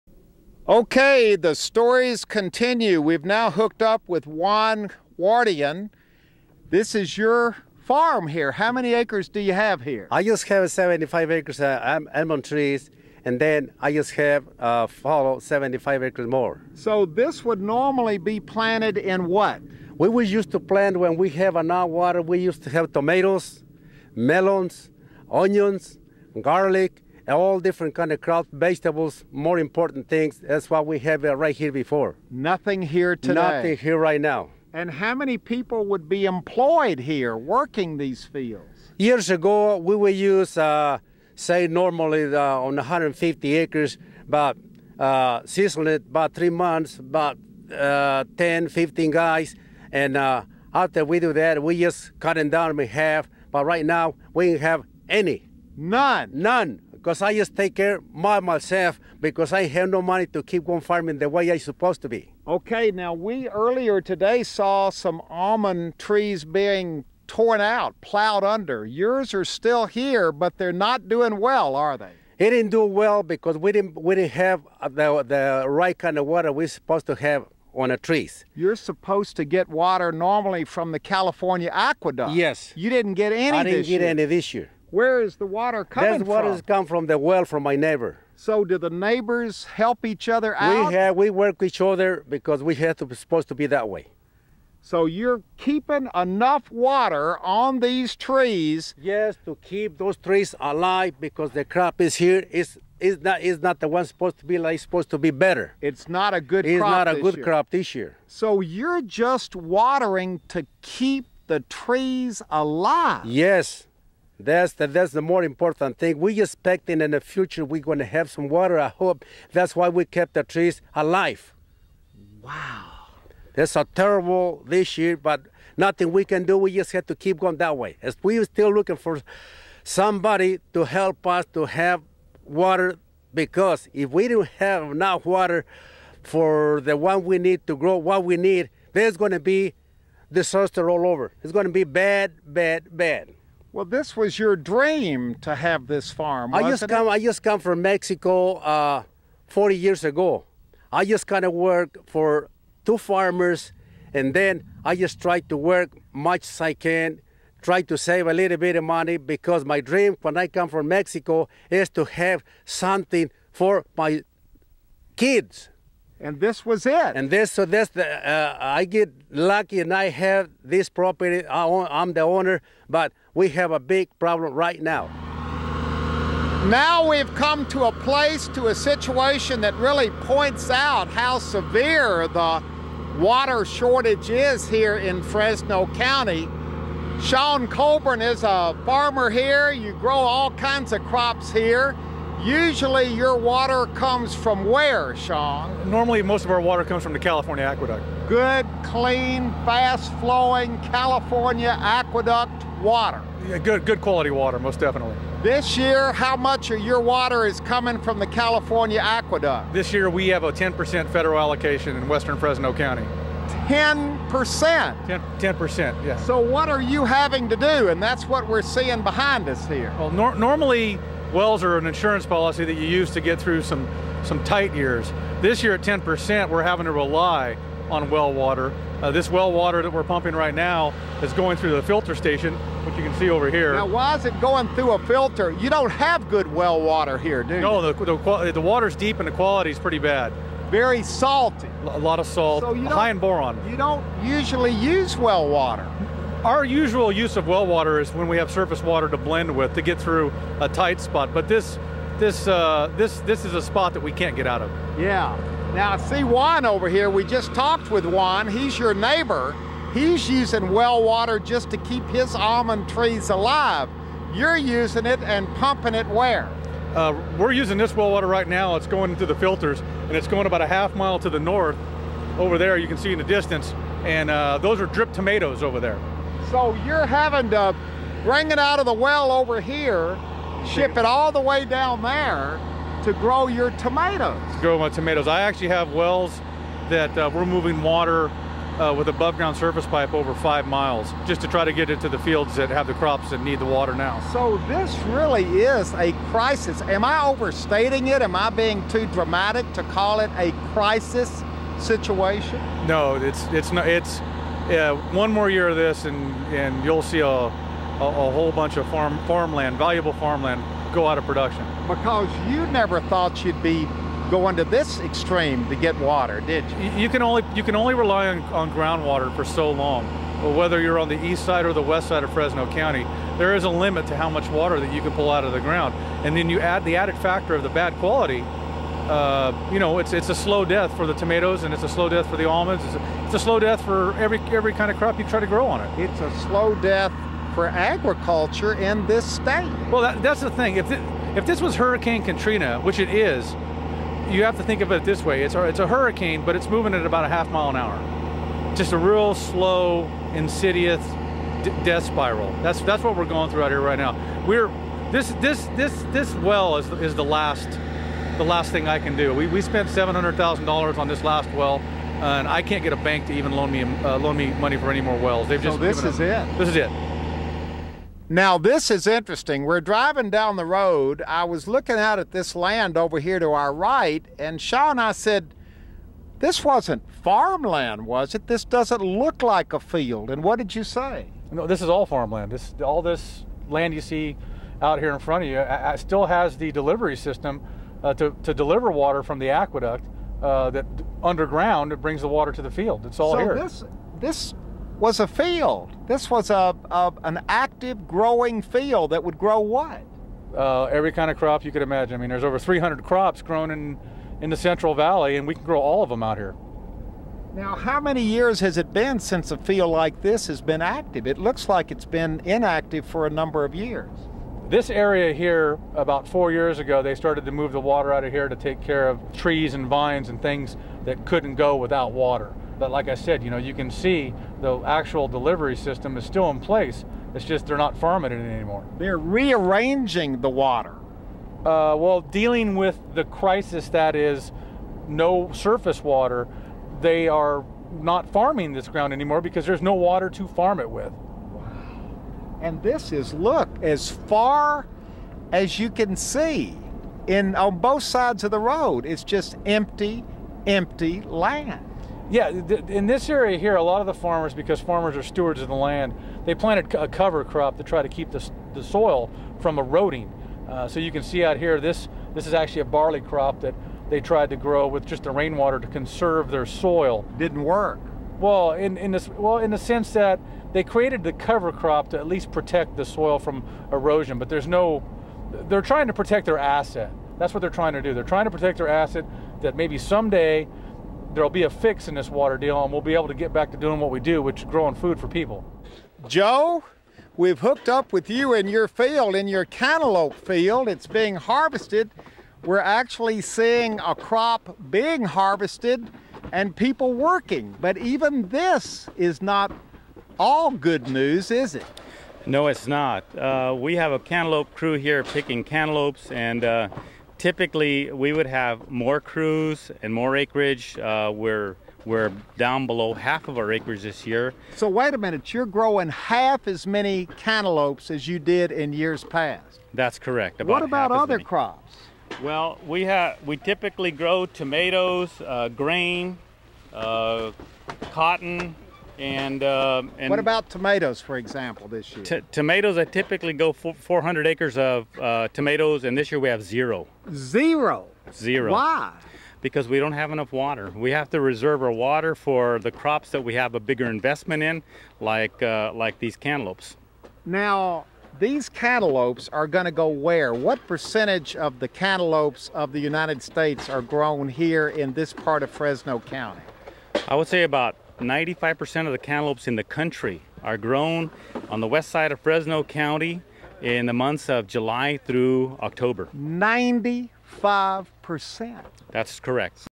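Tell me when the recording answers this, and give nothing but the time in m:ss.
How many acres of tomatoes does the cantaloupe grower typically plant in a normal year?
8:53.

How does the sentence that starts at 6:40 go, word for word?
Uh, every kind of crop you could imagine.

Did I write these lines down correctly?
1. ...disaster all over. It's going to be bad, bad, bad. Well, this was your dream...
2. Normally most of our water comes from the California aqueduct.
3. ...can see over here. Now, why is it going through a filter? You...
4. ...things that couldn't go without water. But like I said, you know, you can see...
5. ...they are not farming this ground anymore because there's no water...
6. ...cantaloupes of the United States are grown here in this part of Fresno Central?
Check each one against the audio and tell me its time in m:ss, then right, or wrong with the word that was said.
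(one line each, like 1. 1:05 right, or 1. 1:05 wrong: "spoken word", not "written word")
1. 2:20 right
2. 3:15 right
3. 3:53 right
4. 7:00 right
5. 7:17 right
6. 9:11 wrong: "County", not "Central".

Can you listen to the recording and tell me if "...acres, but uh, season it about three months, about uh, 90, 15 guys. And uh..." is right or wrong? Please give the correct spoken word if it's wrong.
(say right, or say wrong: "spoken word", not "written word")
wrong: "10", not "90".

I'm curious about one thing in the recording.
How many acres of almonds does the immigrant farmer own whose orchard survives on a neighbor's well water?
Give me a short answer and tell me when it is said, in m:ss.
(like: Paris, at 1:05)
75, at 0:10.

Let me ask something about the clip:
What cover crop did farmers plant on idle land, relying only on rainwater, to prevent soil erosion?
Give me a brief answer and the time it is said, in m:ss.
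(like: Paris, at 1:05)
Barley, at 7:42.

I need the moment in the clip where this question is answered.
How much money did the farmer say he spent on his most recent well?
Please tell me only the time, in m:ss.
5:59.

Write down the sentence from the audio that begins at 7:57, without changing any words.
That's what they're trying to do.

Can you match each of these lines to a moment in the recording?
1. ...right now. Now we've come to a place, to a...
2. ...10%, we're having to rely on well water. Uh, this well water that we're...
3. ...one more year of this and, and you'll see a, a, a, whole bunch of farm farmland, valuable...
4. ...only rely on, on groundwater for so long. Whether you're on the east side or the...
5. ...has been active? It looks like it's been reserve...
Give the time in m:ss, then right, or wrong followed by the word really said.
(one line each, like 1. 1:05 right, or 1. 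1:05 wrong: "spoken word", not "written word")
1. 2:54 right
2. 3:45 right
3. 5:05 right
4. 5:17 right
5. 6:50 wrong: "inactive", not "reserve".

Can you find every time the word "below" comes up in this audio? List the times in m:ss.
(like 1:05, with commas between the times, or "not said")
8:32.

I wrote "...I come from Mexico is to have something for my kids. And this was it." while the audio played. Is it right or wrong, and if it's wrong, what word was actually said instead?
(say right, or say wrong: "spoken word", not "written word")
right.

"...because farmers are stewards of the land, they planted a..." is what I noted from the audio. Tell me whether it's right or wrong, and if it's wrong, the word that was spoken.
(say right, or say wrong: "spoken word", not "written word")
right.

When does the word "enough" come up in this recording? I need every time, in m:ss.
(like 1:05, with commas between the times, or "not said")
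0:21, 1:36, 2:14, 9:00.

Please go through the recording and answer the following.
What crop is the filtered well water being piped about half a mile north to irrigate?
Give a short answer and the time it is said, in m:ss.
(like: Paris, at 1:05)
Drip tomatoes, at 4:34.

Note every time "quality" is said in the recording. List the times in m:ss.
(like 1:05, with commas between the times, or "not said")
3:24, 3:59, 5:27.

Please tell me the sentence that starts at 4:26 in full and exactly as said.
Uh, we're using this well water right now.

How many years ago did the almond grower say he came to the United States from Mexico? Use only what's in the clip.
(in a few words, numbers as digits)
40 years.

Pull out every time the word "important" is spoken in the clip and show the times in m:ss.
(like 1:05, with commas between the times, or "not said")
0:29, 1:55.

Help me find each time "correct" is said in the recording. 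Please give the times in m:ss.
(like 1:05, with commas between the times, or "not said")
8:40, 9:29.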